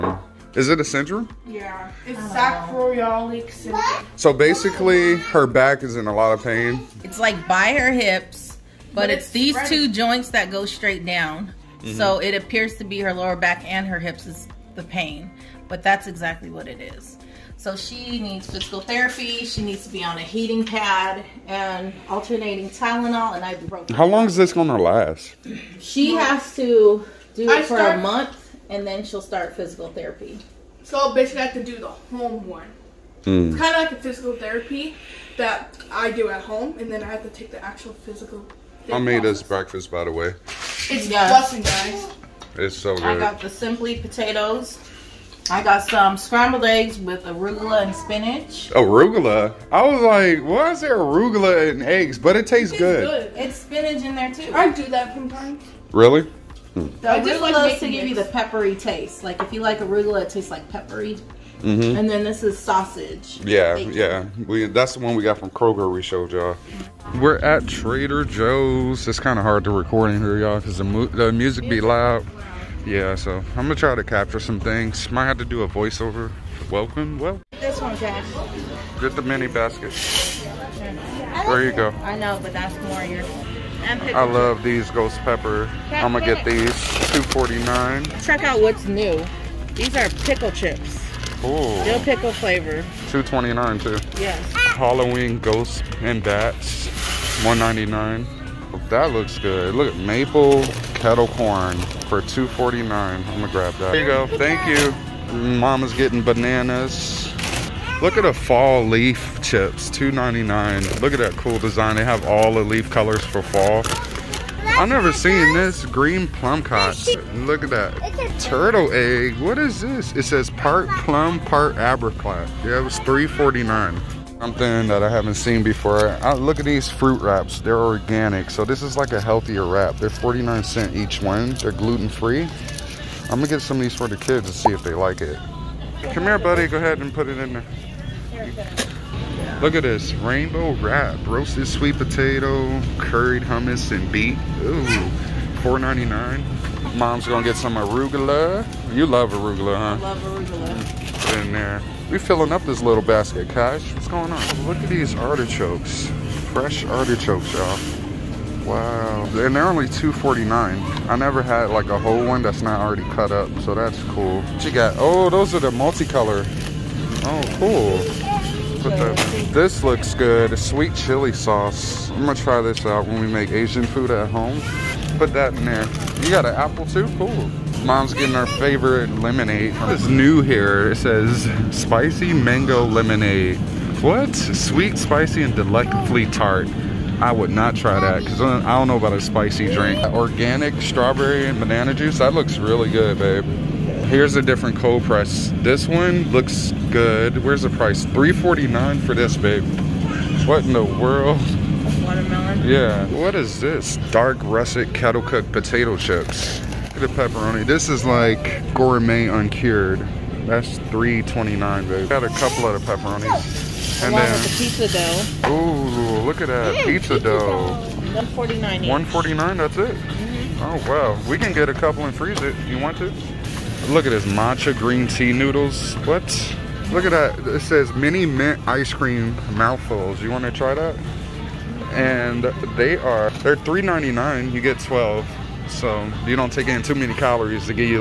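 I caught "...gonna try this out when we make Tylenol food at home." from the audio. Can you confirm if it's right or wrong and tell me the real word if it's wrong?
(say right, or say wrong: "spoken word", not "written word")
wrong: "Asian", not "Tylenol".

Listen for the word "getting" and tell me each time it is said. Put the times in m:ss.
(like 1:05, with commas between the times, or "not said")
1:45, 2:58.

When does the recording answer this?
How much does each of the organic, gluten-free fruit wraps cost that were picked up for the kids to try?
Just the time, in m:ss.
2:10.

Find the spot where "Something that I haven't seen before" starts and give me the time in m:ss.
2:04.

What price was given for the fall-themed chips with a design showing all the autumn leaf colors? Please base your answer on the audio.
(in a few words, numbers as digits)
$2.99.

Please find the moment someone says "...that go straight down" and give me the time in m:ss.
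0:10.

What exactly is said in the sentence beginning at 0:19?
She needs to be on a heating pad and alternating Tylenol and ibuprofen.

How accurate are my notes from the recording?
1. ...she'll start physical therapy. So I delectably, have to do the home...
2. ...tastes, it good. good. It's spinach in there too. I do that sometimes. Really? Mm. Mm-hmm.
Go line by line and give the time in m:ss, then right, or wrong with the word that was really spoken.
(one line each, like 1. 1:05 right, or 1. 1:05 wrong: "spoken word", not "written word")
1. 0:29 wrong: "basically", not "delectably"
2. 0:52 right.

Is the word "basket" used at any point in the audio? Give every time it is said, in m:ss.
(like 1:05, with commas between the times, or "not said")
1:19, 2:33.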